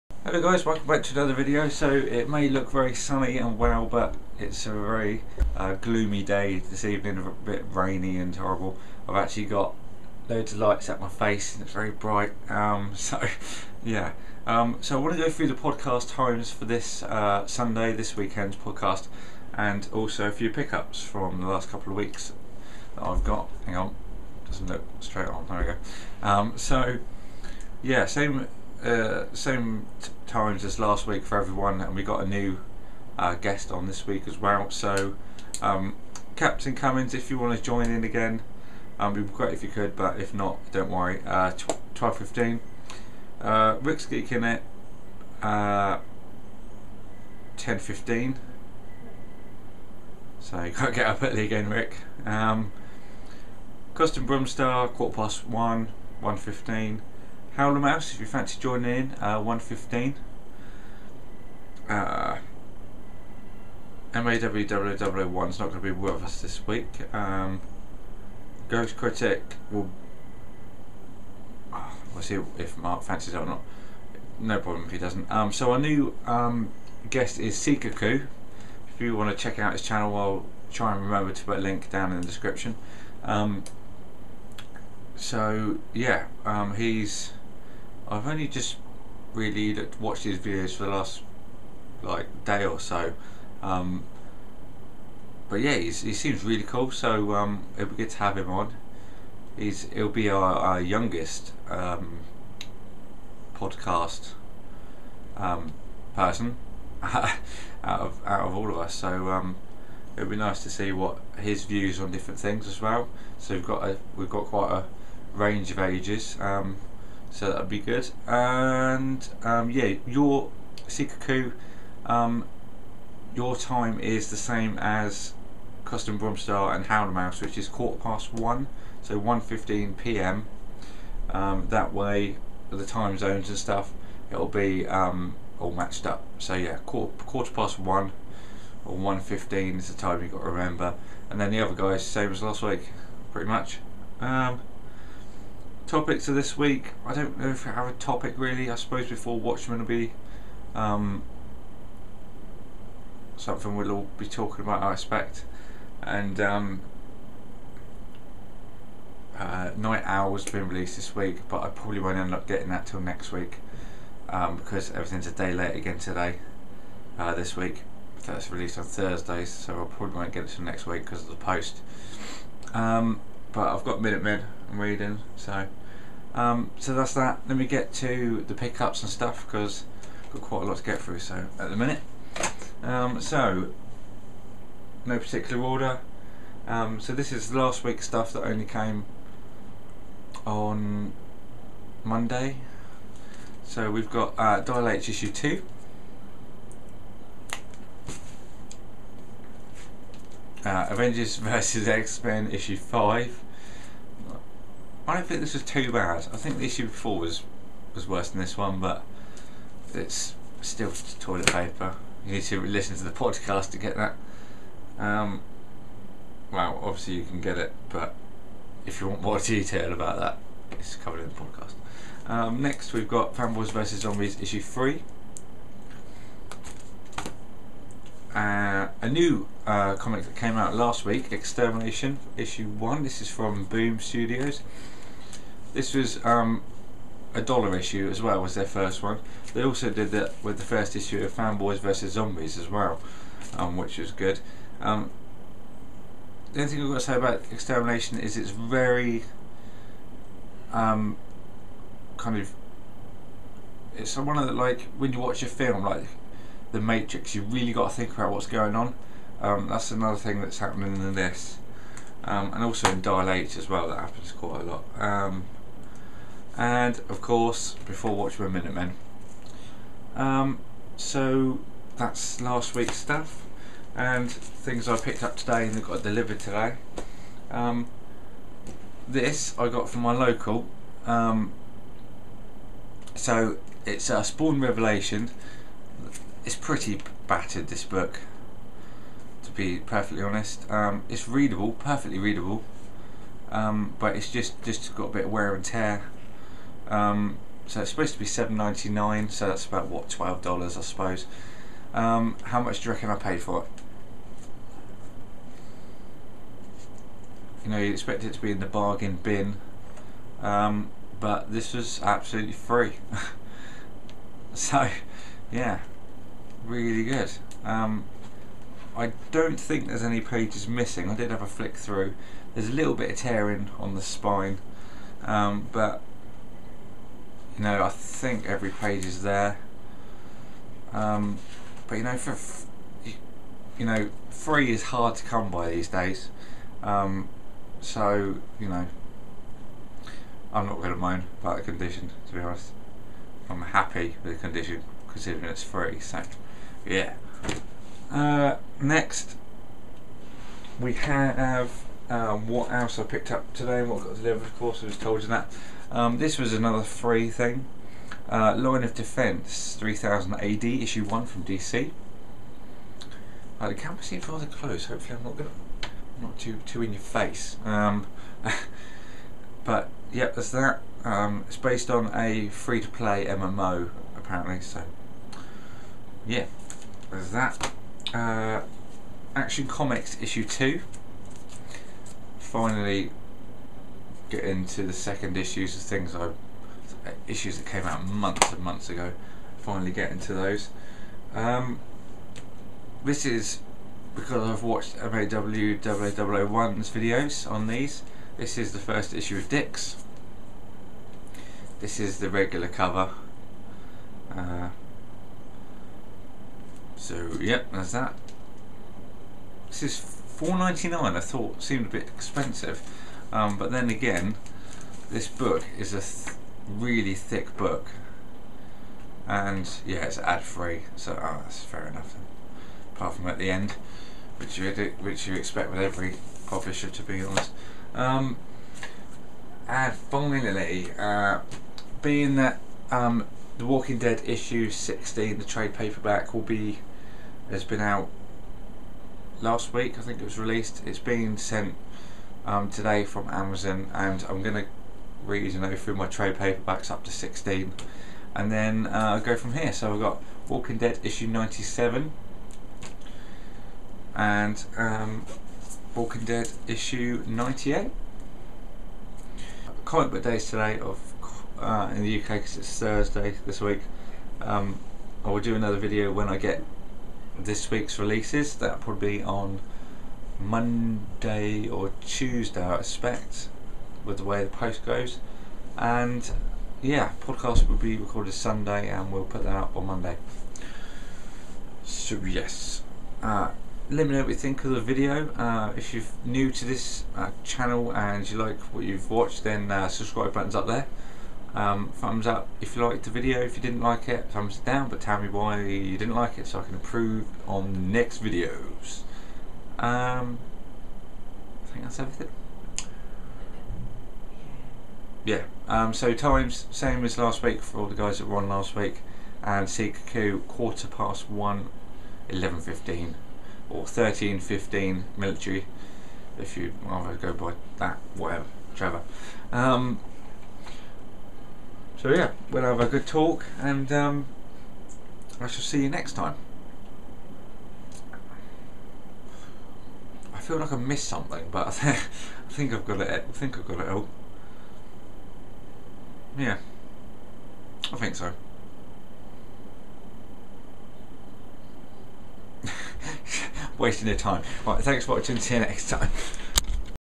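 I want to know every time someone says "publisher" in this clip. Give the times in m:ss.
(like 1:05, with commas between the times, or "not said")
7:06.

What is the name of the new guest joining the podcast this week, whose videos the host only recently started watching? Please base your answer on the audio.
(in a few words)
Seekaku.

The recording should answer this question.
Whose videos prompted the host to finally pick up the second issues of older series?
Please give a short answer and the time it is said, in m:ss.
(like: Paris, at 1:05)
MAW 0001, at 6:34.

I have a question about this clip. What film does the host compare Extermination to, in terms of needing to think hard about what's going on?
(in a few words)
The Matrix.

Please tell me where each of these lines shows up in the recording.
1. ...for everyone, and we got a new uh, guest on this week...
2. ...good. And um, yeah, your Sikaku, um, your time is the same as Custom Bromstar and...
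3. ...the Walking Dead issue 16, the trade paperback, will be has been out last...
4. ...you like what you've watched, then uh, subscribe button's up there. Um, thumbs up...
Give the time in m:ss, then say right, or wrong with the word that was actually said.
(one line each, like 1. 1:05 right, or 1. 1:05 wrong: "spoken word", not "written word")
1. 0:31 right
2. 1:57 right
3. 7:13 right
4. 8:08 right.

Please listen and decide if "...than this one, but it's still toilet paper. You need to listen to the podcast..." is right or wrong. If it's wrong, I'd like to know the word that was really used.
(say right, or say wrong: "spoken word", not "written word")
right.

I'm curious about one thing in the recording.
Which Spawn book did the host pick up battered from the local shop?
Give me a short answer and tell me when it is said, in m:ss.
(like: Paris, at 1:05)
Spawn Revelation, at 4:44.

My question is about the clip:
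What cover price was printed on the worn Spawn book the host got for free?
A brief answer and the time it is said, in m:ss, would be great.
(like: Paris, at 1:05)
7.99, at 4:58.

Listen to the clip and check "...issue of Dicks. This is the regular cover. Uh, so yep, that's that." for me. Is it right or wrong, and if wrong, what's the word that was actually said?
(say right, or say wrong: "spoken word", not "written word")
right.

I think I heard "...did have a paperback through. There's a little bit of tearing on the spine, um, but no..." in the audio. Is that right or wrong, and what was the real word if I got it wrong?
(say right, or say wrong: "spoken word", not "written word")
wrong: "flick", not "paperback".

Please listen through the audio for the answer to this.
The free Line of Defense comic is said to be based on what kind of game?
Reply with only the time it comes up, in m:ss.
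6:12.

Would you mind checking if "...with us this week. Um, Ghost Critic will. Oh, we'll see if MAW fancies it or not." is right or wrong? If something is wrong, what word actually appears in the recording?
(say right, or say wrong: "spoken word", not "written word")
wrong: "Mark", not "MAW".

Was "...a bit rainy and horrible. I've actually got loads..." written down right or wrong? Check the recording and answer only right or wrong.
right.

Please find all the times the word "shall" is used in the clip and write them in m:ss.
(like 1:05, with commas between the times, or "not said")
8:45.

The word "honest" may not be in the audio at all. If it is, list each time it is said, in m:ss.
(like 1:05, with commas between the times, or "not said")
4:50, 5:42, 7:07.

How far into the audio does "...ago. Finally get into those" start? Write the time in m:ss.
6:28.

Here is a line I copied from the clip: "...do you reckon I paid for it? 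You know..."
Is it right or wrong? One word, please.
right.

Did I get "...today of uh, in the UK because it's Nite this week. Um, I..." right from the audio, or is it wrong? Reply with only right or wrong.
wrong.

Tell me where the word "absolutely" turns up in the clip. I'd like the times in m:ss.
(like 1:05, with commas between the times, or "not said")
5:12.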